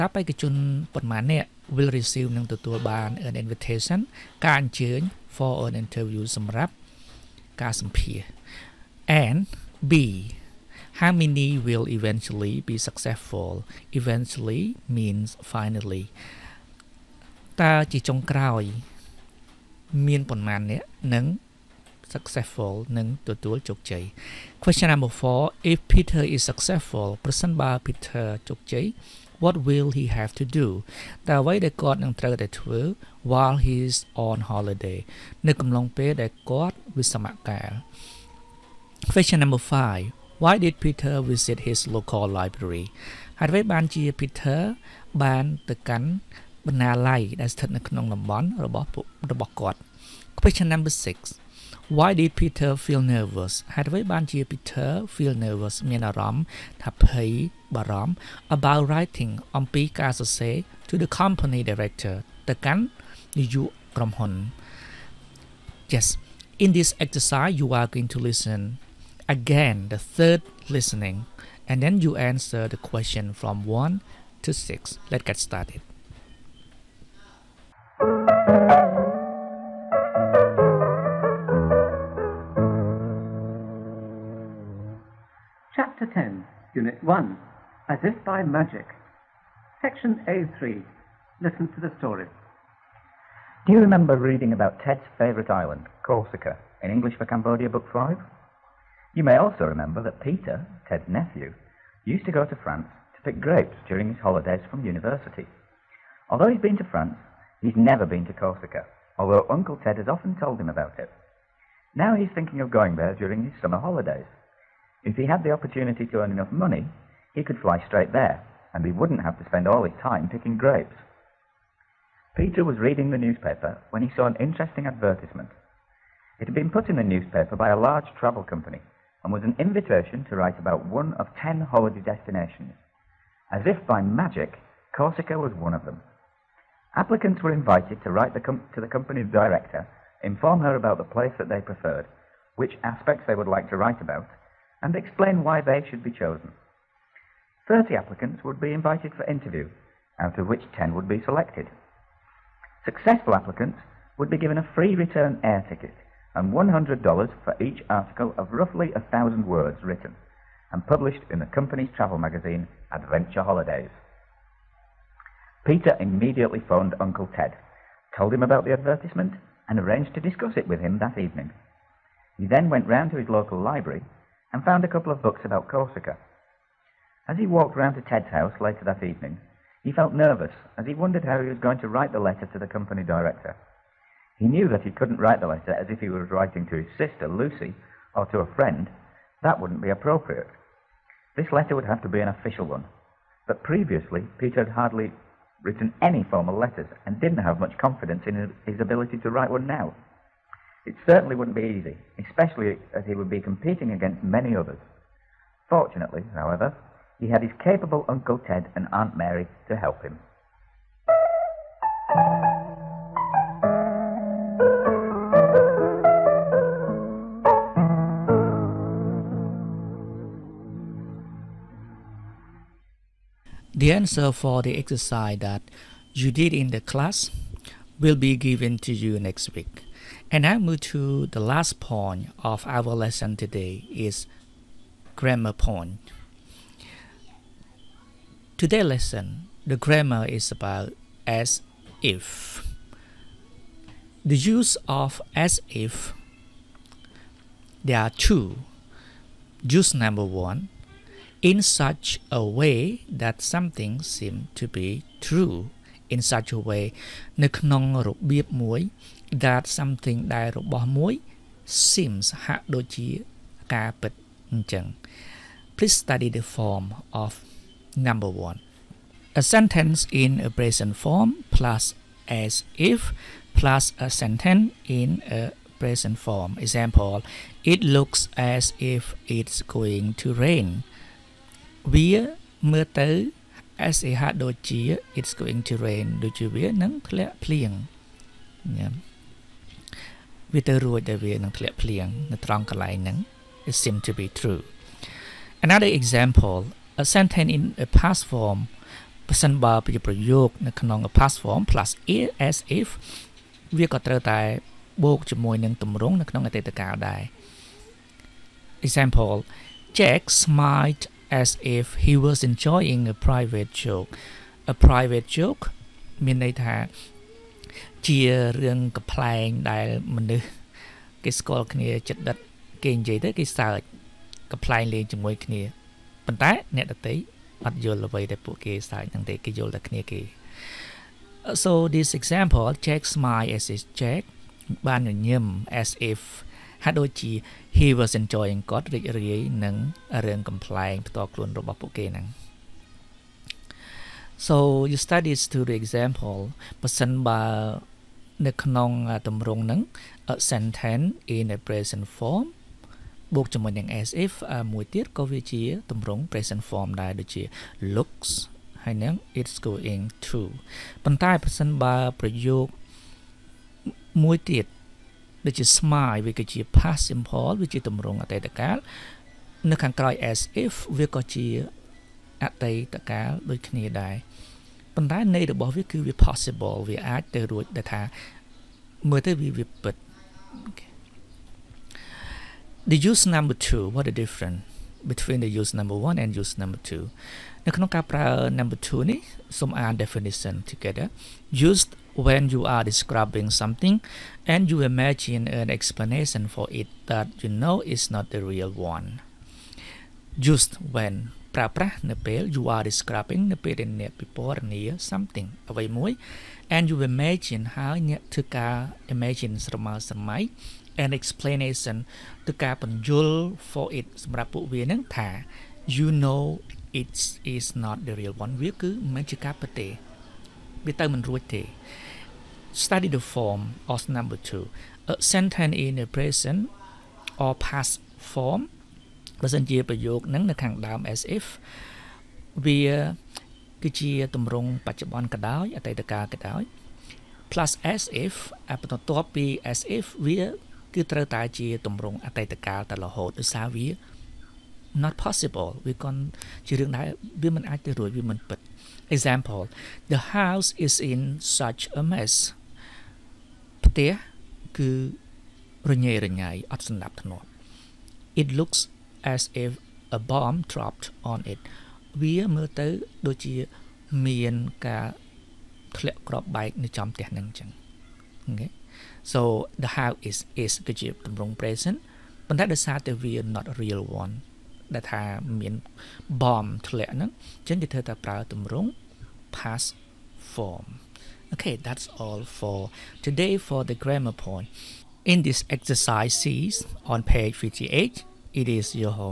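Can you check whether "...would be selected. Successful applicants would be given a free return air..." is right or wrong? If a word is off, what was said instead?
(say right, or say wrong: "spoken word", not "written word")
right.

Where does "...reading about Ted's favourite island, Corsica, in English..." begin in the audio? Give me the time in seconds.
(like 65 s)
94 s.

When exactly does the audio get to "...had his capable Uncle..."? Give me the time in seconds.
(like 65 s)
207 s.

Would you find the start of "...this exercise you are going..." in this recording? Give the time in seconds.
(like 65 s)
66 s.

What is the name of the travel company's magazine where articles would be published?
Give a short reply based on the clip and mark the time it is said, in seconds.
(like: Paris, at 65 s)
Adventure Holidays, at 162 s.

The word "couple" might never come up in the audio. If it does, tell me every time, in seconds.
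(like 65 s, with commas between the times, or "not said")
174 s.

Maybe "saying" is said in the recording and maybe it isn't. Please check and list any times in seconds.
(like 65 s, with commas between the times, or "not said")
not said.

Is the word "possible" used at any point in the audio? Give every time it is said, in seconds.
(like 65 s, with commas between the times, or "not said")
376 s, 445 s.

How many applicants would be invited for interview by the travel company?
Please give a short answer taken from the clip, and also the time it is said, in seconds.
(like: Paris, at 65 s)
30, at 147 s.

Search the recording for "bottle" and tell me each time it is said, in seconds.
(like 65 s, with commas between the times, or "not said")
not said.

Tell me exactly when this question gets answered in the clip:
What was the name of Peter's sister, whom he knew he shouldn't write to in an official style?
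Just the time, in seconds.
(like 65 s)
187 s.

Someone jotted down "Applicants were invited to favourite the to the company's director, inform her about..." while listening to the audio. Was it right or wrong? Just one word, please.
wrong.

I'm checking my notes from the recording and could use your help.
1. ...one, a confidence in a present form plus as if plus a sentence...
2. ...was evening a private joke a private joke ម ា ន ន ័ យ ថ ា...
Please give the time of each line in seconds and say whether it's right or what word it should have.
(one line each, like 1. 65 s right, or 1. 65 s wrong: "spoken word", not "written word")
1. 268 s wrong: "sentence", not "confidence"
2. 312 s wrong: "enjoying", not "evening".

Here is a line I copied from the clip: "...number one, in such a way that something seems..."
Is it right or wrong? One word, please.
right.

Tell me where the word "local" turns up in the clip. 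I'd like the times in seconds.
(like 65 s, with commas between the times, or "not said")
41 s, 173 s.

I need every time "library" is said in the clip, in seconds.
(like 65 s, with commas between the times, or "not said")
42 s, 173 s.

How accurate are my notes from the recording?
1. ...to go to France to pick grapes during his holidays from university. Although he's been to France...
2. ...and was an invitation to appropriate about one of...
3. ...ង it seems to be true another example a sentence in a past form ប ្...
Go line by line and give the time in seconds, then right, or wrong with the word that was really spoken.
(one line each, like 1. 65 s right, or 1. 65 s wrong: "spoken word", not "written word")
1. 102 s right
2. 129 s wrong: "write", not "appropriate"
3. 293 s right.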